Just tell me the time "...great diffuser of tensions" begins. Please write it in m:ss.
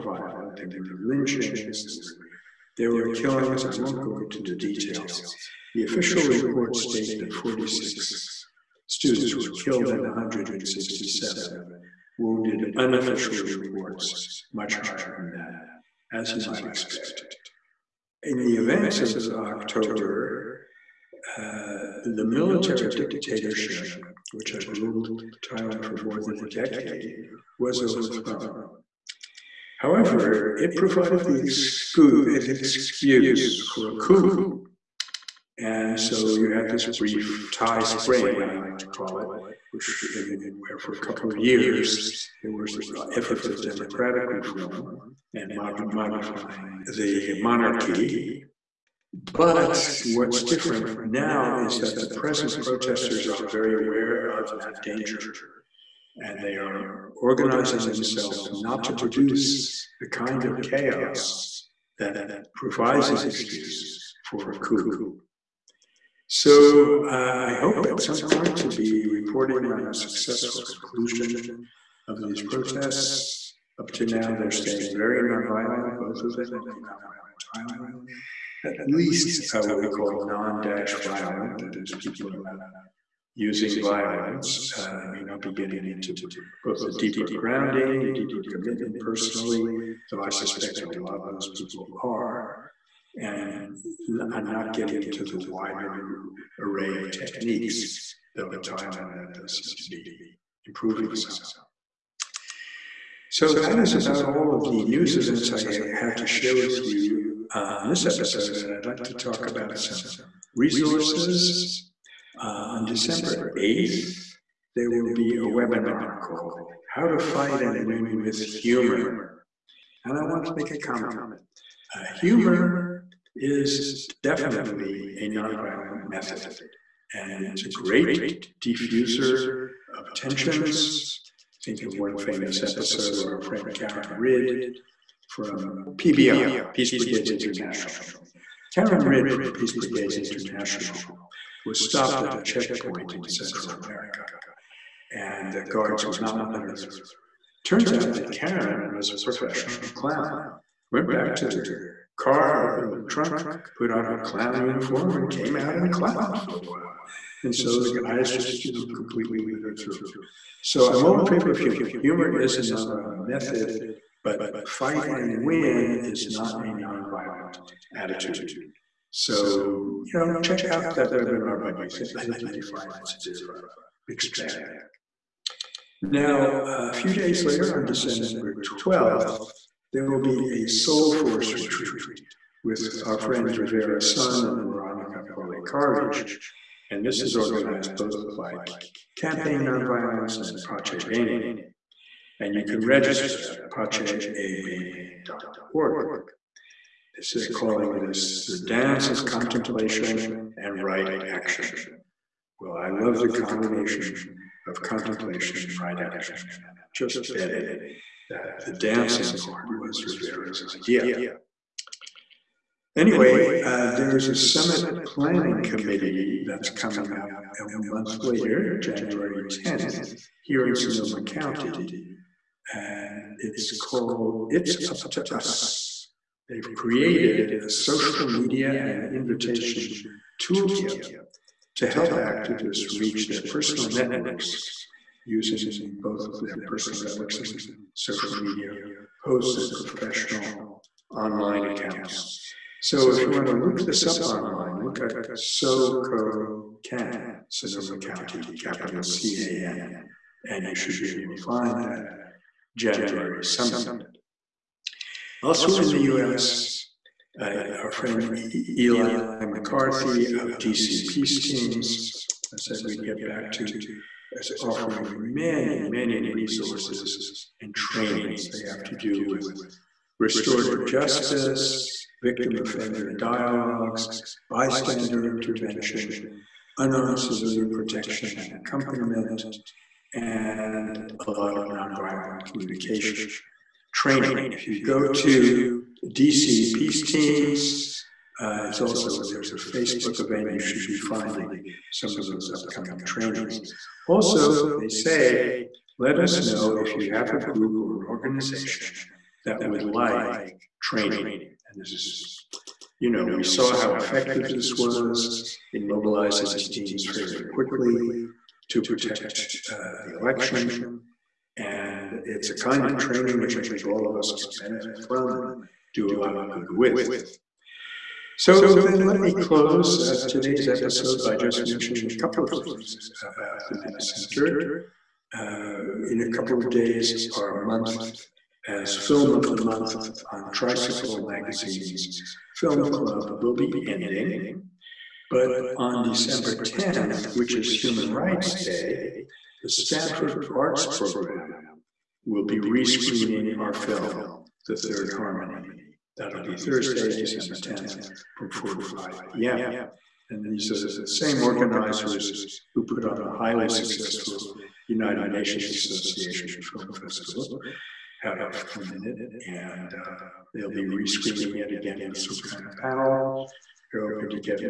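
2:07.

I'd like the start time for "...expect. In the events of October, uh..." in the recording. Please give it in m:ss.
0:16.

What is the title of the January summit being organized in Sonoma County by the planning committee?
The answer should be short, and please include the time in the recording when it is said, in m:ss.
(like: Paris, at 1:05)
It's Up to Us, at 3:44.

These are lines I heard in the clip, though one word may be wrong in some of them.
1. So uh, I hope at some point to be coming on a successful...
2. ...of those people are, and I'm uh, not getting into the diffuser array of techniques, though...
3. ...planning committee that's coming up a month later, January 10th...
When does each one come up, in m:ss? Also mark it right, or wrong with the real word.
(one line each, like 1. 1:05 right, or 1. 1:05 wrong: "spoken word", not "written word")
1. 1:06 wrong: "reporting", not "coming"
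2. 1:31 wrong: "wider", not "diffuser"
3. 3:35 right.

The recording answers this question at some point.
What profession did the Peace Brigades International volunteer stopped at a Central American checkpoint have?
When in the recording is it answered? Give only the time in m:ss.
2:29.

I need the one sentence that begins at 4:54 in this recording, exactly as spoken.
Also, they say, let us know if you have a group or an organization that would like training.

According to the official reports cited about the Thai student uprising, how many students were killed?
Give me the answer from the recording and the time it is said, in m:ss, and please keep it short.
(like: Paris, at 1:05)
46, at 0:07.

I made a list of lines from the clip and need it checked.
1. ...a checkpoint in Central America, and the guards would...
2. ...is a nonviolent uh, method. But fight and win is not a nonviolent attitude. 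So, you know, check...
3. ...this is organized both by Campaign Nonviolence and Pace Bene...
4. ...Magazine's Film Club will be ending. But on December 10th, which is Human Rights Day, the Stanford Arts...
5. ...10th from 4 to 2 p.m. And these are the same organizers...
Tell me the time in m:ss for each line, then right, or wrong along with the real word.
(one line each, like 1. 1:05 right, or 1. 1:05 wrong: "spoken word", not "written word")
1. 2:22 right
2. 2:42 right
3. 3:07 right
4. 5:31 right
5. 5:47 wrong: "5", not "2".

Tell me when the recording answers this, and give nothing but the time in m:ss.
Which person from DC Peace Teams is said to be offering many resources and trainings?
4:18.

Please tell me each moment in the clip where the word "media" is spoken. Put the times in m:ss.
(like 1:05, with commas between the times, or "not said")
3:48, 3:58.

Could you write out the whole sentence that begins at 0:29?
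However, it provided the, excuse for a coup.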